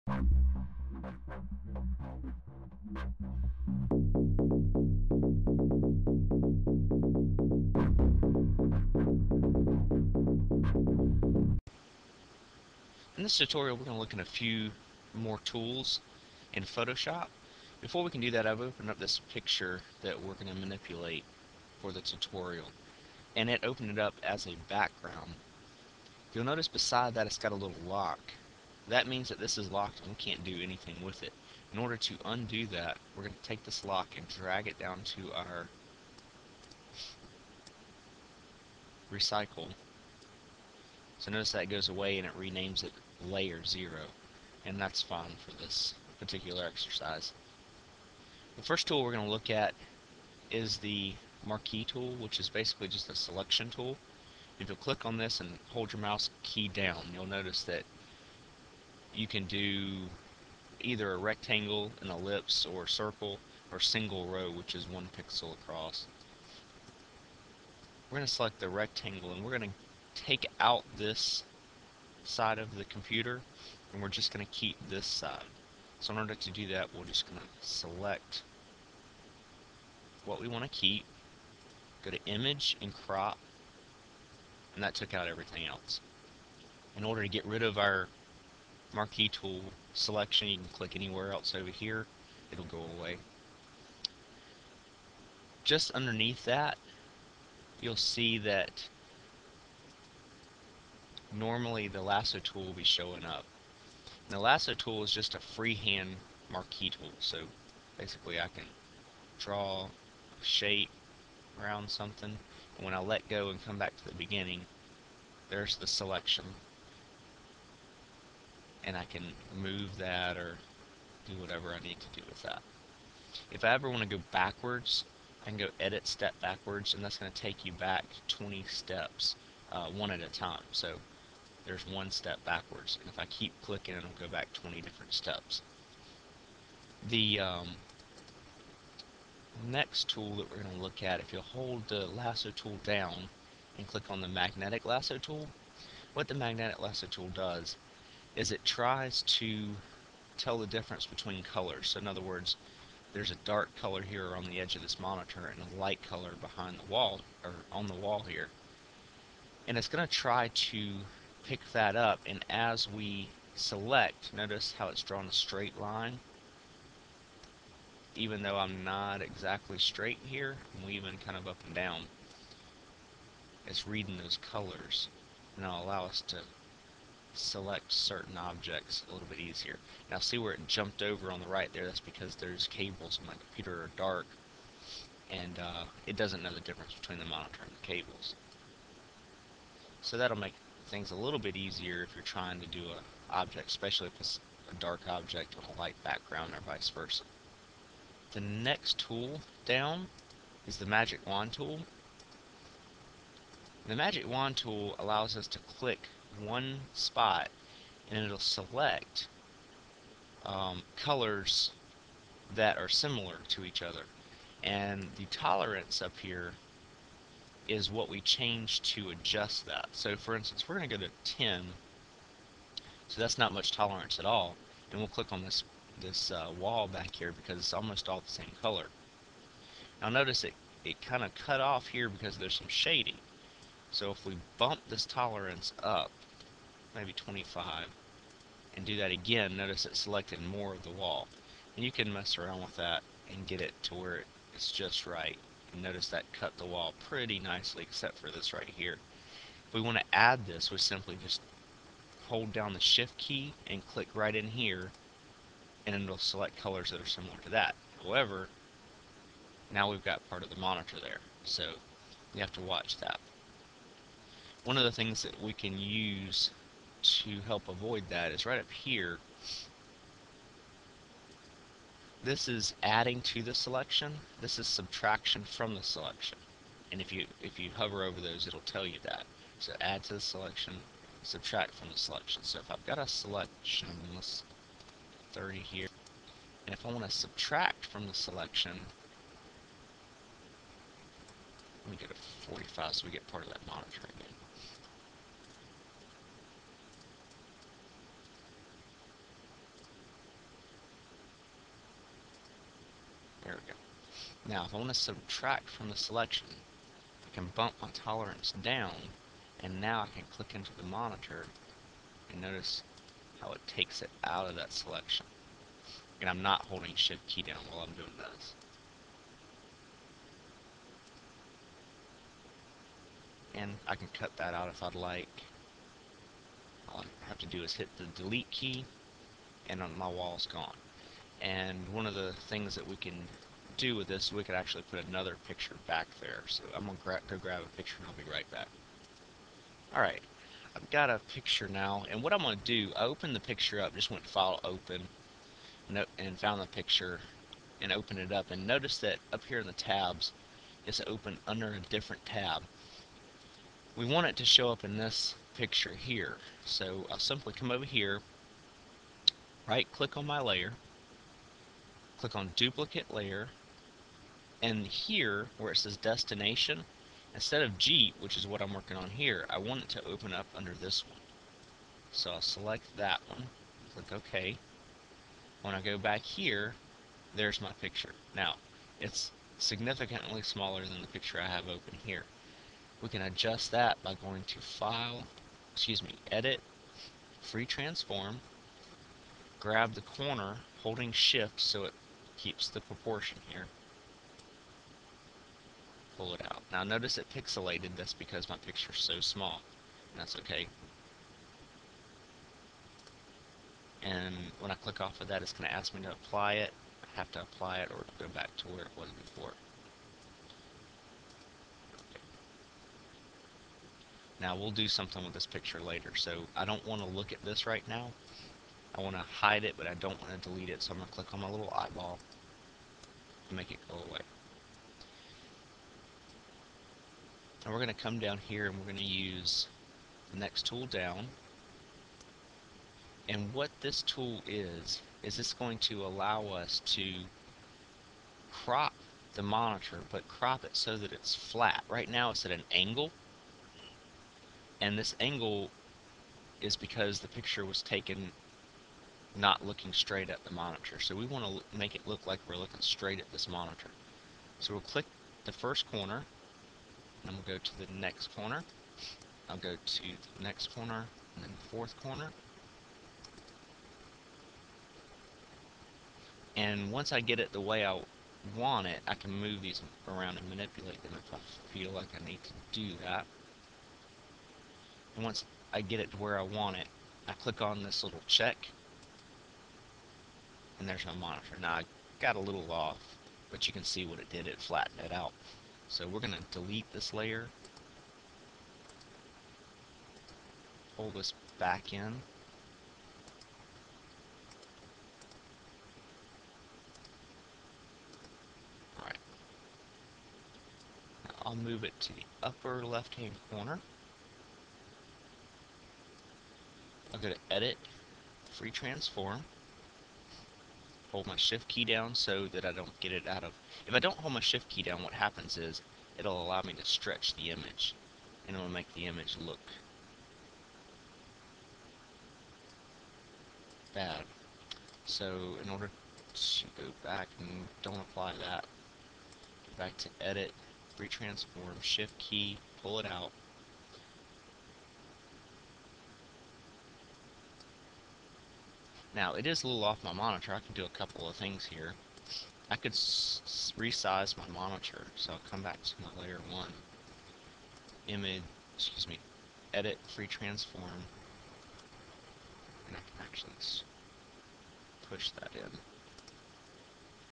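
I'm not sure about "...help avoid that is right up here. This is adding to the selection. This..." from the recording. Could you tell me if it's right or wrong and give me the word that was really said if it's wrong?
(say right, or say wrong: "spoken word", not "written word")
right.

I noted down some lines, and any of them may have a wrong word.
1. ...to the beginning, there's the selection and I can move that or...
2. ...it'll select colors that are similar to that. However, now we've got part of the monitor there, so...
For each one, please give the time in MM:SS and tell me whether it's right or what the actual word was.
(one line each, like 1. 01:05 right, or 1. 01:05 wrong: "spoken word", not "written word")
1. 01:53 right
2. 04:16 right.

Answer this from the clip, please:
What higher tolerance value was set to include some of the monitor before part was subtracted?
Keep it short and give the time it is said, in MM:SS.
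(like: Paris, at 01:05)
45, at 04:52.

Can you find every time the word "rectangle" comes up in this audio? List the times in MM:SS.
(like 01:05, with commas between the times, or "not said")
01:01, 01:08.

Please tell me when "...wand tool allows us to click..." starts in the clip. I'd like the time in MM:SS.
03:24.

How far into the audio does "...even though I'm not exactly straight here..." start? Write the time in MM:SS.
02:48.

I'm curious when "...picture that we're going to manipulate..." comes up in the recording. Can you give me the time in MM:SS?
00:19.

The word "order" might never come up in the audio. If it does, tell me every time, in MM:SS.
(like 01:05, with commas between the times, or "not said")
00:31, 01:16, 01:27, 08:45.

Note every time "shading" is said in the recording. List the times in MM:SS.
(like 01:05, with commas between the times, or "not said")
03:52.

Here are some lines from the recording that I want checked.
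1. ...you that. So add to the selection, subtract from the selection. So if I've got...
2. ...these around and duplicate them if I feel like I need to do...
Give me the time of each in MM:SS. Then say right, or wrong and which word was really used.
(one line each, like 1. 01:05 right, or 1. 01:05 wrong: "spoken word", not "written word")
1. 04:38 right
2. 07:49 wrong: "manipulate", not "duplicate".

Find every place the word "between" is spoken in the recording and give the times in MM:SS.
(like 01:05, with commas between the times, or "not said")
02:31, 03:06.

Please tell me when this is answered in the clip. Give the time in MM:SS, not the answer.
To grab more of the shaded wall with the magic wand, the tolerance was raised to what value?
03:57.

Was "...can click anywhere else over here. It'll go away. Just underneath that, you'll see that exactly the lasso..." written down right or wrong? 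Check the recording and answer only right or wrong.
wrong.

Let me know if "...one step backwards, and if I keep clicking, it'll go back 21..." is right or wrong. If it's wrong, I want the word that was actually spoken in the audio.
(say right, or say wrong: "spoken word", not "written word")
wrong: "20", not "21".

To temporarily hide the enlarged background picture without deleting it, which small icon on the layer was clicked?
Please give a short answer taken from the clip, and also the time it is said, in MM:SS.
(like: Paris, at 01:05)
eyeball, at 07:01.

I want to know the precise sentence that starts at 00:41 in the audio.
So notice that goes away and it renames it layer 0.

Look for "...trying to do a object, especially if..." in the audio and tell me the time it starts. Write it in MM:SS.
03:12.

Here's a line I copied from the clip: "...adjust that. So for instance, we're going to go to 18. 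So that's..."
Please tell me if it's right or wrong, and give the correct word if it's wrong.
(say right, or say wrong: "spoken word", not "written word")
wrong: "10", not "18".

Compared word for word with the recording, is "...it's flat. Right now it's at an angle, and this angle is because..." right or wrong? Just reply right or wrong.
right.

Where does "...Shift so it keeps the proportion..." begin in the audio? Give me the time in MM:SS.
06:31.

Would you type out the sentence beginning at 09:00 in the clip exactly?
I can do a couple of things here.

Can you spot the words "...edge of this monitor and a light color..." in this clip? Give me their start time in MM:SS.
02:34.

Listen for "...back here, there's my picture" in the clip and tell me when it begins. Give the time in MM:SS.
06:15.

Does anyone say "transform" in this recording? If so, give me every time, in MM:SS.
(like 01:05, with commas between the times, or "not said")
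06:27, 08:28, 08:51, 09:10.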